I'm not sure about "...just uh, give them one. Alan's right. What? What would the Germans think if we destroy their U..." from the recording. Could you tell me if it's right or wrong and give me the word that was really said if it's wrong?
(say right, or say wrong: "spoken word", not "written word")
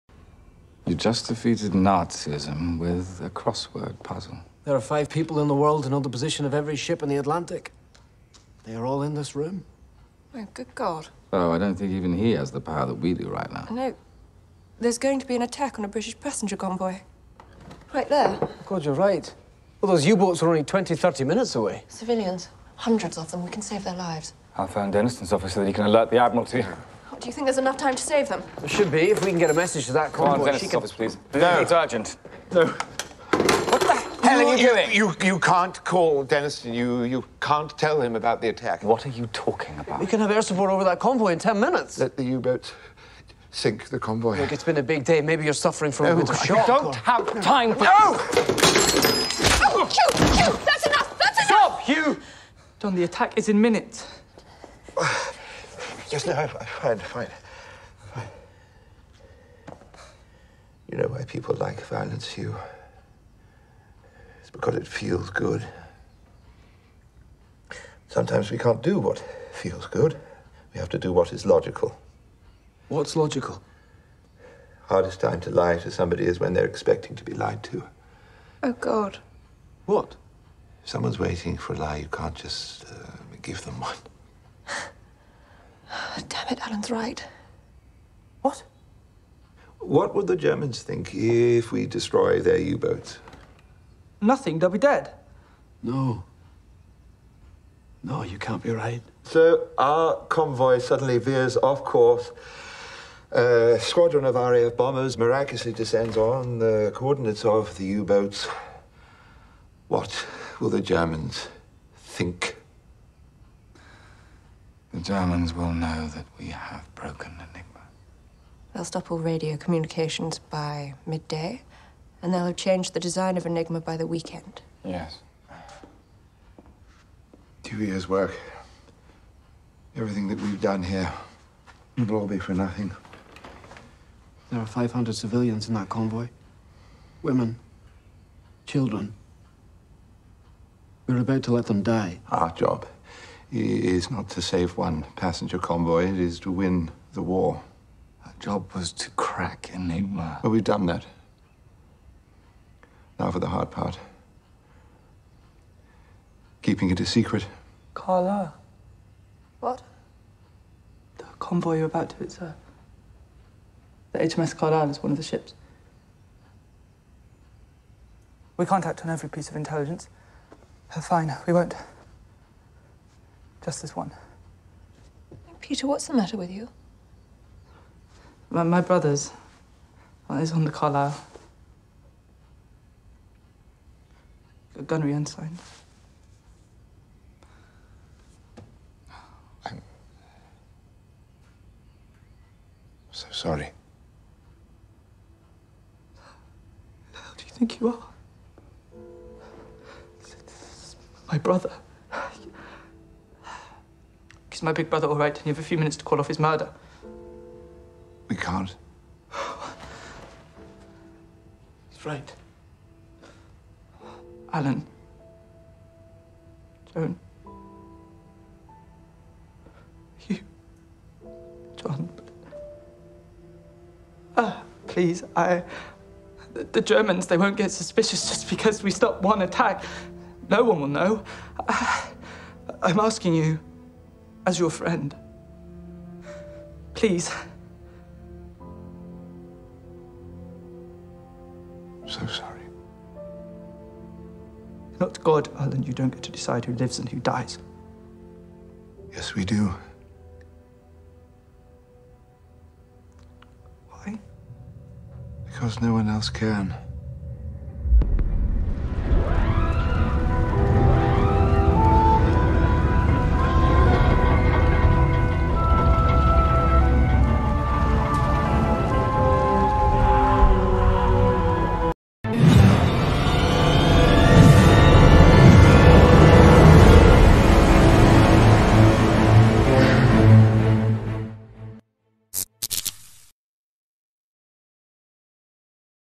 right.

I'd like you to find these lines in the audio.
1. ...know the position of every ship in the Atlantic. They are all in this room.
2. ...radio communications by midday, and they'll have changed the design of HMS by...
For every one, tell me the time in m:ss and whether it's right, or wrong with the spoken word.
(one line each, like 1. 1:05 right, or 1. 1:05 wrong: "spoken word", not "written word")
1. 0:05 right
2. 1:59 wrong: "Enigma", not "HMS".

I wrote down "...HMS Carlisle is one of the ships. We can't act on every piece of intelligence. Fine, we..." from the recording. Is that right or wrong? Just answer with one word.
right.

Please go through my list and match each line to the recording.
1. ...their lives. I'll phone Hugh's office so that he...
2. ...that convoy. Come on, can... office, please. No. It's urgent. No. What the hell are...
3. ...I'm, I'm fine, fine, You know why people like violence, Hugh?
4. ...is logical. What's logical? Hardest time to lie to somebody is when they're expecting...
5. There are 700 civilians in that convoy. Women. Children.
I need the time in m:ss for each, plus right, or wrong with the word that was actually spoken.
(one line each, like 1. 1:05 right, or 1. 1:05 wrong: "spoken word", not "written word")
1. 0:23 wrong: "Denniston", not "Hugh"
2. 0:29 right
3. 0:56 right
4. 1:11 right
5. 2:14 wrong: "500", not "700".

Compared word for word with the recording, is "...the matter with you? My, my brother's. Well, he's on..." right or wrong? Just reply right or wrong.
right.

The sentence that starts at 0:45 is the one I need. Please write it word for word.
Maybe you're suffering from no, a bit of shock.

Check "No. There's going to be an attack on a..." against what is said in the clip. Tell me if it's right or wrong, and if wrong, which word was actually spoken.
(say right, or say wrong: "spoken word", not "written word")
right.